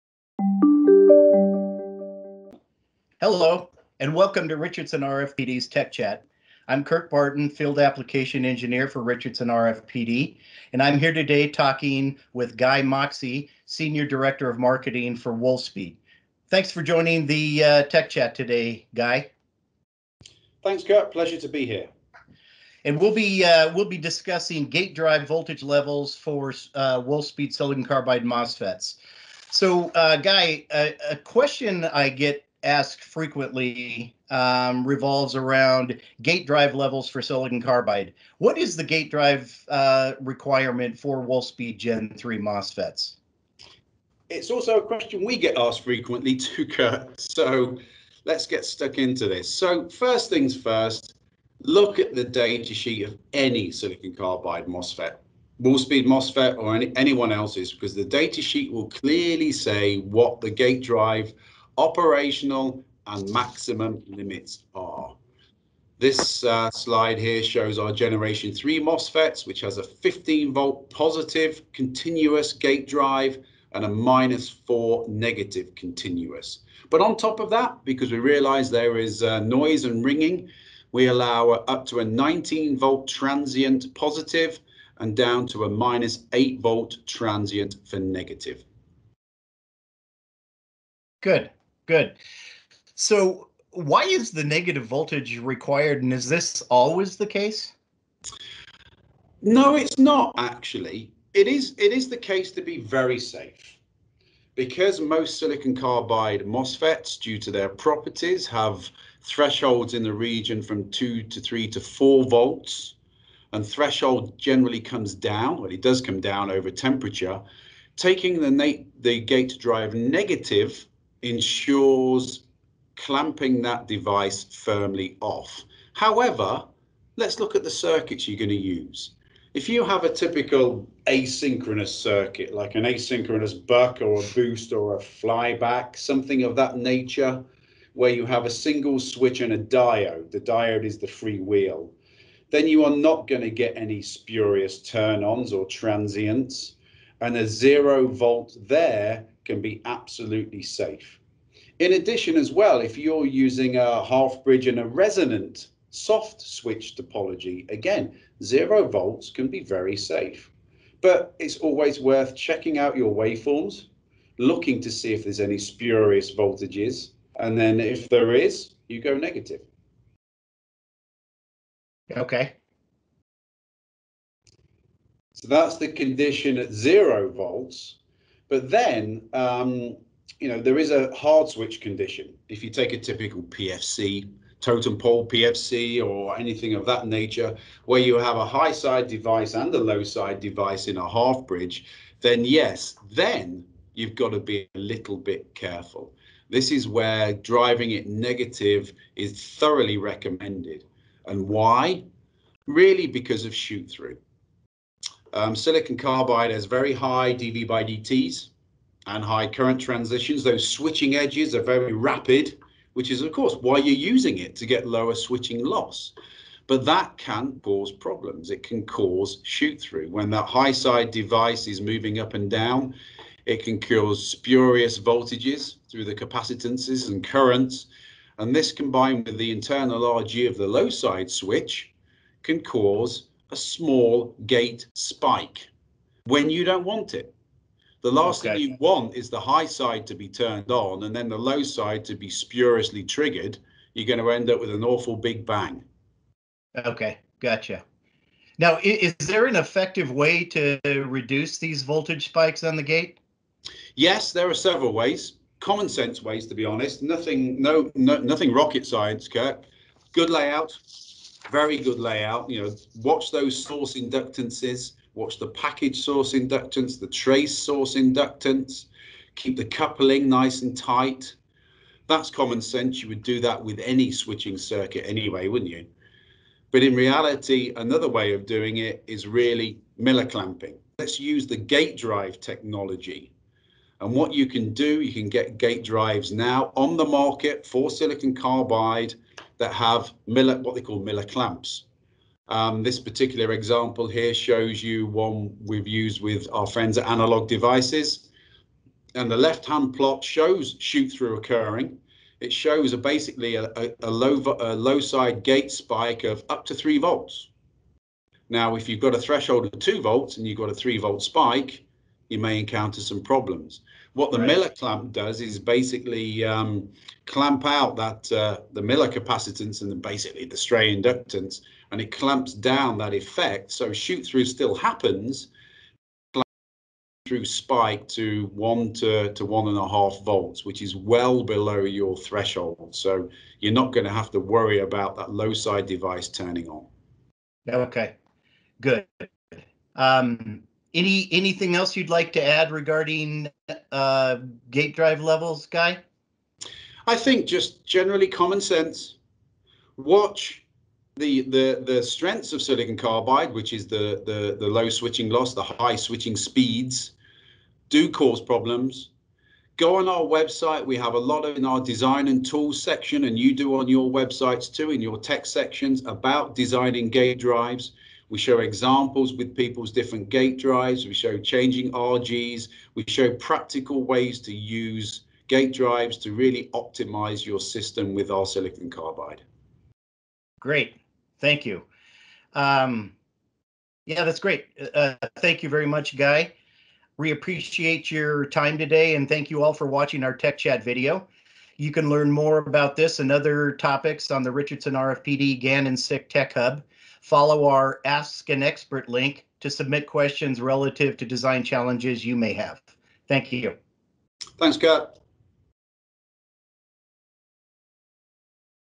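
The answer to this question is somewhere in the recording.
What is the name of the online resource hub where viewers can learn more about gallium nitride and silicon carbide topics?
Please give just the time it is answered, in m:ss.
6:35.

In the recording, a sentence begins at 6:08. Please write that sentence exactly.
We show examples with people's different gate drives.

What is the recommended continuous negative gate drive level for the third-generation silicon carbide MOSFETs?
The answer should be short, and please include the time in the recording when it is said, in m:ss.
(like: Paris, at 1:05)
minus 4, at 1:13.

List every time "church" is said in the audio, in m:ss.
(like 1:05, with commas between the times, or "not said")
not said.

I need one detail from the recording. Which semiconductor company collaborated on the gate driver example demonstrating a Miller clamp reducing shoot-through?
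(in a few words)
Analog Devices.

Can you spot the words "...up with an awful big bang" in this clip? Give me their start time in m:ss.
4:04.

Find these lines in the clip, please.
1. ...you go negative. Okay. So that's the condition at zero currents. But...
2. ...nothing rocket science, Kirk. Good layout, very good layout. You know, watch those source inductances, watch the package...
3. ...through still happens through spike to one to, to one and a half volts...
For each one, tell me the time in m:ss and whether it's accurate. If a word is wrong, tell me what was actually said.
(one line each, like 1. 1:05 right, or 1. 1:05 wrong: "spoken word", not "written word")
1. 2:48 wrong: "volts", not "currents"
2. 4:18 right
3. 5:24 right.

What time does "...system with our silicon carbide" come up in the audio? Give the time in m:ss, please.
6:17.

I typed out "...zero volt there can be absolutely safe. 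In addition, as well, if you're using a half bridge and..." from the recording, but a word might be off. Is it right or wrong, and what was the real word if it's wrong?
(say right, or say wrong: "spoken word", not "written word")
right.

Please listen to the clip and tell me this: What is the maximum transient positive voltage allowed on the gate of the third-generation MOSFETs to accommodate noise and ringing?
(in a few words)
19 volt.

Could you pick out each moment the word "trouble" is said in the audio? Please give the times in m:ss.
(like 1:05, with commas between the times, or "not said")
not said.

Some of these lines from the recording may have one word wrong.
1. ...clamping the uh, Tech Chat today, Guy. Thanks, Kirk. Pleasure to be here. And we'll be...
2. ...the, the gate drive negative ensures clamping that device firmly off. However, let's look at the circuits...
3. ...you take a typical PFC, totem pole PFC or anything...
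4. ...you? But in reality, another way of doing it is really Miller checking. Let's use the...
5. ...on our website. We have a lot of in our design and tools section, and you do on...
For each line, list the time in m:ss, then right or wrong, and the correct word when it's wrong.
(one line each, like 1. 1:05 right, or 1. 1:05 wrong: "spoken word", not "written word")
1. 0:16 wrong: "joining", not "clamping"
2. 1:58 right
3. 3:02 right
4. 4:35 wrong: "clamping", not "checking"
5. 5:59 right.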